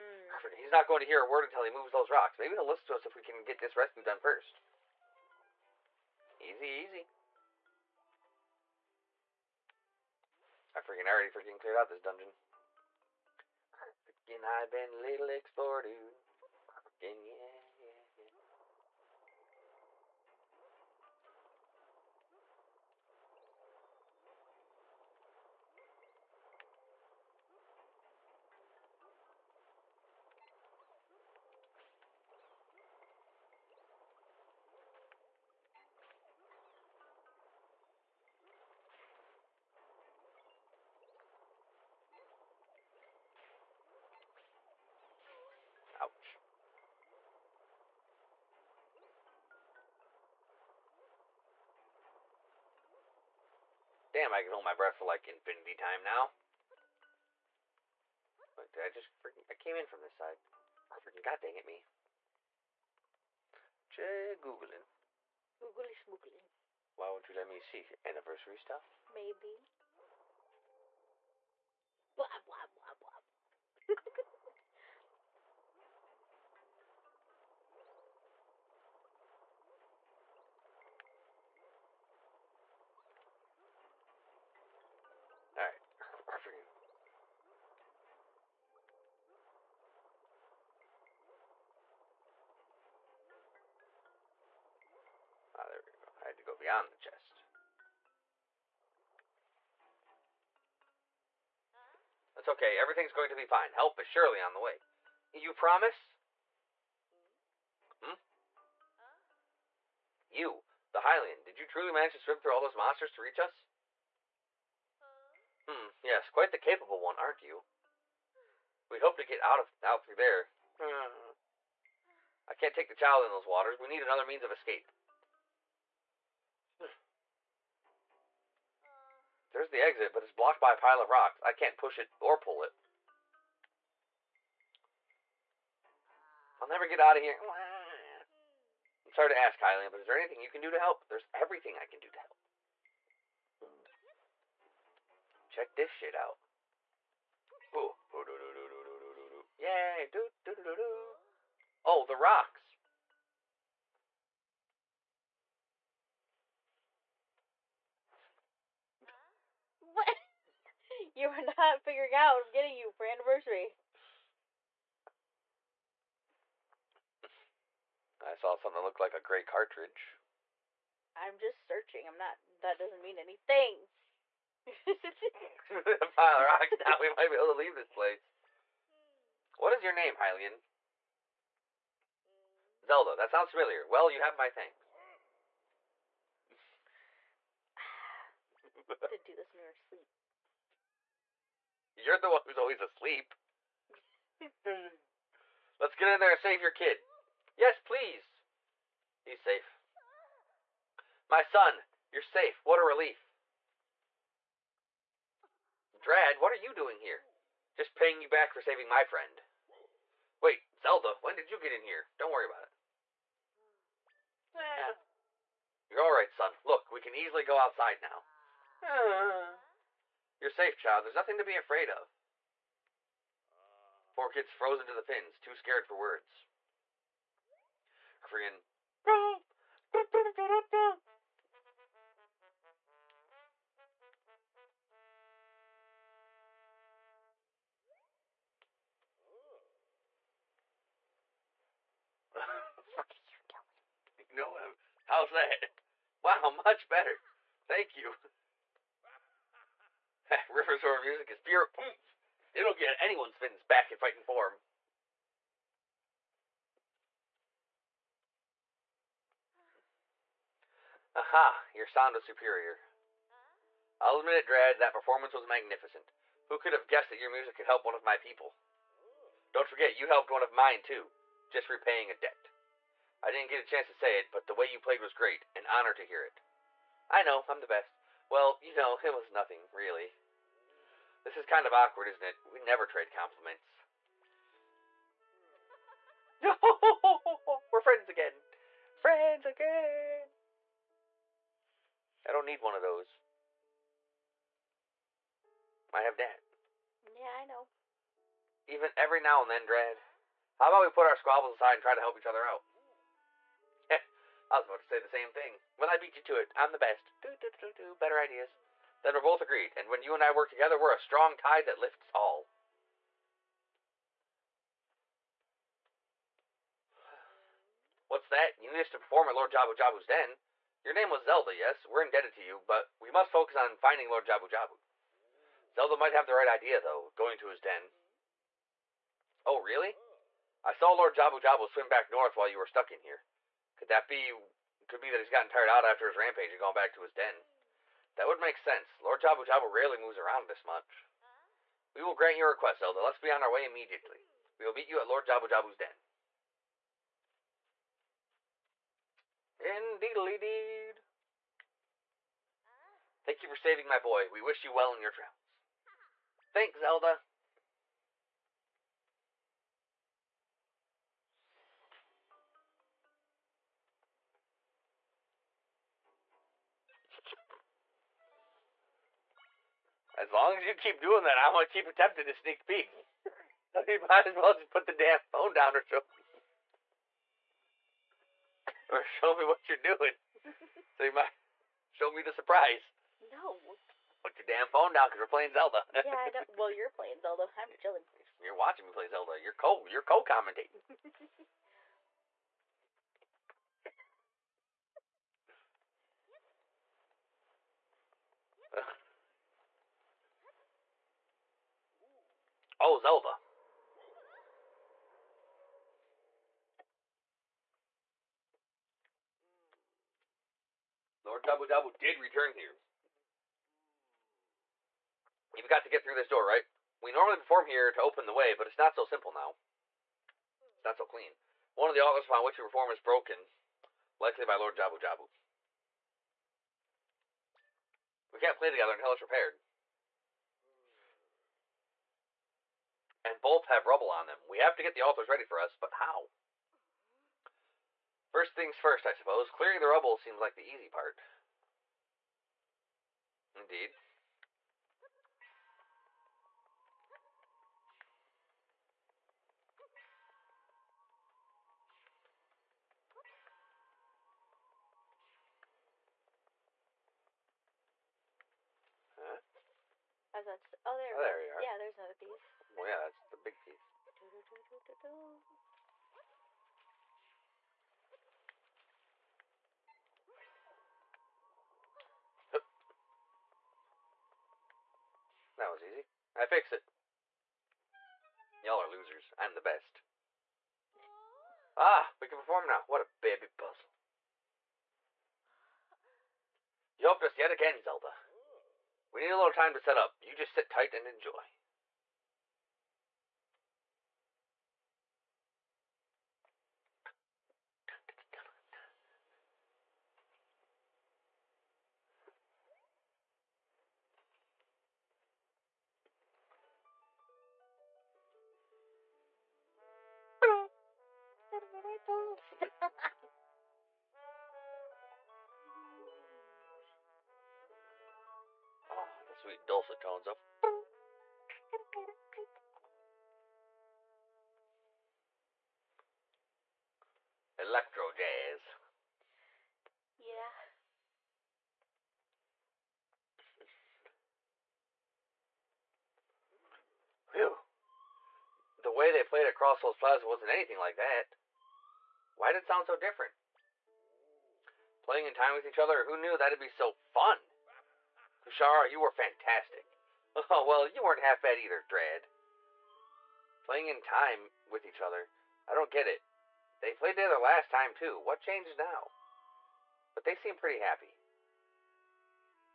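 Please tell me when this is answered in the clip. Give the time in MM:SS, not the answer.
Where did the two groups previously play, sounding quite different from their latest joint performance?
08:59.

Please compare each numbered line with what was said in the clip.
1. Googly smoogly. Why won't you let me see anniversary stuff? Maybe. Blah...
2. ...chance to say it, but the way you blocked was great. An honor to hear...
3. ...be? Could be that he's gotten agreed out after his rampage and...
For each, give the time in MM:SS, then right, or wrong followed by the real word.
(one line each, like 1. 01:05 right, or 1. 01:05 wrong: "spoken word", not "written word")
1. 01:05 right
2. 04:33 wrong: "played", not "blocked"
3. 05:34 wrong: "tired", not "agreed".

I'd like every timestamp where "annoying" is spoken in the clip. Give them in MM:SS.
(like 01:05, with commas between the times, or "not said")
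not said.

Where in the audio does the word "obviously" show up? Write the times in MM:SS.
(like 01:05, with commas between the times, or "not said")
not said.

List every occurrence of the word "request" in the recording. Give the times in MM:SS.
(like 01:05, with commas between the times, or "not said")
05:42.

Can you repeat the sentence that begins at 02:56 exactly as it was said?
We might be able to leave this place.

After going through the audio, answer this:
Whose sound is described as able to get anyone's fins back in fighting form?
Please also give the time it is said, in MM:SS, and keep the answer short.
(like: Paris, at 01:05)
River Zora, at 04:10.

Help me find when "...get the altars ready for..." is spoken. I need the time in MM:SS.
07:14.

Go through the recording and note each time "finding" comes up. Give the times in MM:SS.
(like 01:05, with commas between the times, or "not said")
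05:23.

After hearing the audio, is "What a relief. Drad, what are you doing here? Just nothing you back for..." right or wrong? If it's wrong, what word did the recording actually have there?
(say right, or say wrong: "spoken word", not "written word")
wrong: "paying", not "nothing".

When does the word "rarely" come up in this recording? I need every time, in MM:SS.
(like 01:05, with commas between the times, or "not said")
05:39.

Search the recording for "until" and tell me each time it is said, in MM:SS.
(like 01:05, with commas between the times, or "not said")
00:01, 07:08.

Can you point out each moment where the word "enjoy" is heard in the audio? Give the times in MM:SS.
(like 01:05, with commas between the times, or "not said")
08:11.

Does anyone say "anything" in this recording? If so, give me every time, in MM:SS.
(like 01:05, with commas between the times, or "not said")
02:20, 02:53, 09:00.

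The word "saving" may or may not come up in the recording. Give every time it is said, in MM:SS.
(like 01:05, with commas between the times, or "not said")
03:28, 05:53.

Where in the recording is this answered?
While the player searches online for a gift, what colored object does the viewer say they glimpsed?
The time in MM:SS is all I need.
02:49.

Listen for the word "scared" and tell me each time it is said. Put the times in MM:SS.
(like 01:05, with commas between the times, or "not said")
03:45.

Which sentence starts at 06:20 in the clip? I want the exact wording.
So you might show me the surprise.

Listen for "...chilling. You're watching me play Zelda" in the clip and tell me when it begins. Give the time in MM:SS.
06:27.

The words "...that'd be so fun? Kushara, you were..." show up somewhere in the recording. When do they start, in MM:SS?
09:06.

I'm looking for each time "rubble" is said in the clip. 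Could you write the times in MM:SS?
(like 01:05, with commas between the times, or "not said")
07:13, 07:19.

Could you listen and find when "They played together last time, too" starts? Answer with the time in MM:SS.
09:16.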